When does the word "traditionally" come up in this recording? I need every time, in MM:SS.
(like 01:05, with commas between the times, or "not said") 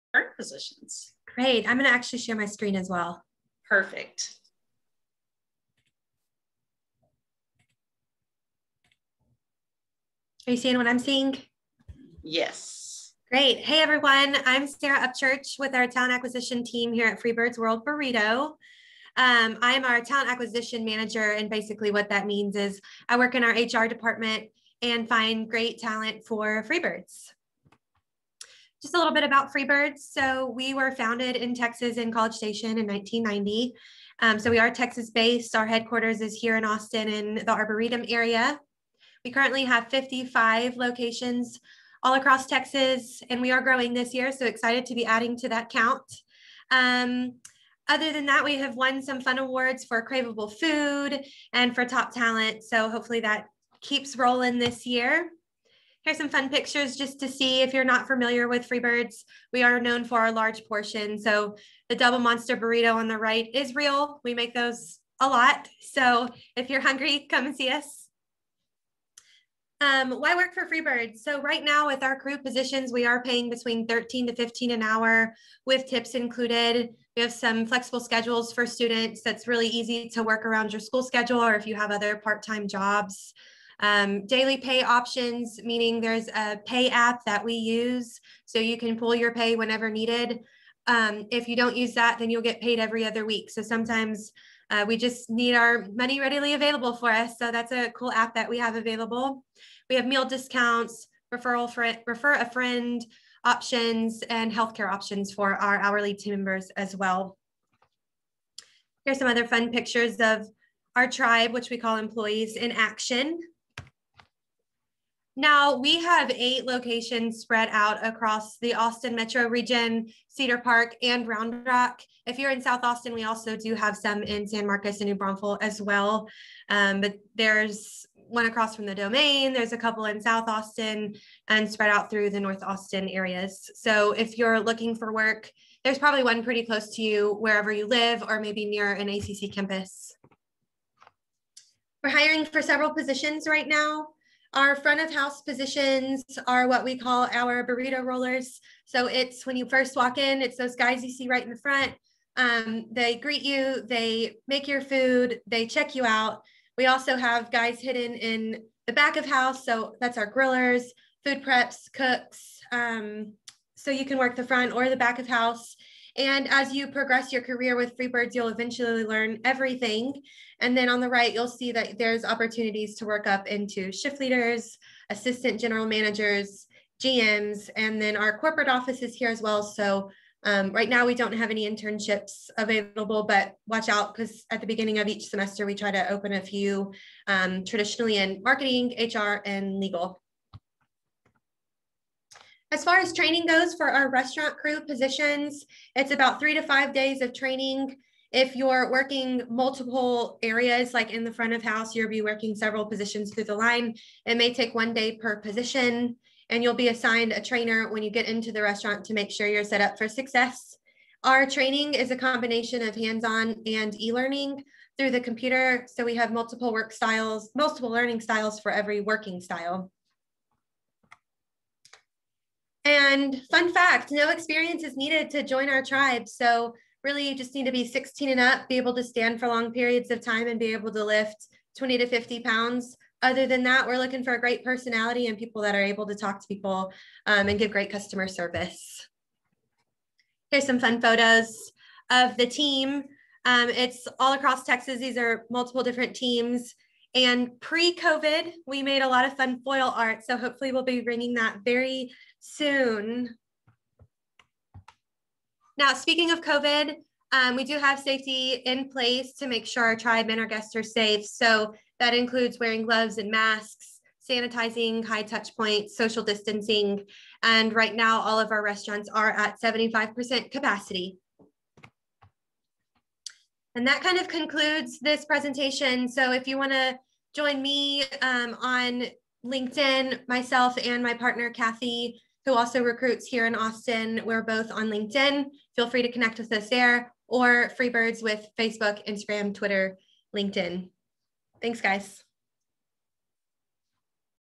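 03:07.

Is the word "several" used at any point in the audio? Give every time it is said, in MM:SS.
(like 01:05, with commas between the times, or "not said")
02:22, 03:22.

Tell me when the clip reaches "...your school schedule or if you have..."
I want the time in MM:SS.
01:20.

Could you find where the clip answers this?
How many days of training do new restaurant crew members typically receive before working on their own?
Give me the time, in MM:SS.
03:16.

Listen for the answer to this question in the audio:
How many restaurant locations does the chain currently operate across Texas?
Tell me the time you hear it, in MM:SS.
00:39.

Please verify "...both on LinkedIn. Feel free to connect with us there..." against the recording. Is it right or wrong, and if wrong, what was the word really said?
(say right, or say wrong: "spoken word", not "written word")
right.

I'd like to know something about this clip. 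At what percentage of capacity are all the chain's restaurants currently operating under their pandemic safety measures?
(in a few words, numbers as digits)
75%.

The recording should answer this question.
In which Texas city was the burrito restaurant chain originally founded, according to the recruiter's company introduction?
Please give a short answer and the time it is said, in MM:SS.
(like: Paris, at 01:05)
College Station, at 00:32.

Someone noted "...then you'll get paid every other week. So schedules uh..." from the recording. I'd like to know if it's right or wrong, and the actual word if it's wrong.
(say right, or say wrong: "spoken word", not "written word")
wrong: "sometimes", not "schedules".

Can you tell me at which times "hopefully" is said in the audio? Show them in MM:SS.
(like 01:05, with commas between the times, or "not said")
00:52, 04:10.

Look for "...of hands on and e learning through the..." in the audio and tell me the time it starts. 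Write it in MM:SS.
03:32.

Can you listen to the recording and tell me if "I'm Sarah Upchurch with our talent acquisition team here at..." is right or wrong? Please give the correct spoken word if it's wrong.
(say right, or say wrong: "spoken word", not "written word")
right.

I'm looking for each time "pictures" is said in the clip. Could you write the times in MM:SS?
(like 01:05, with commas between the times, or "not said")
00:56, 01:49.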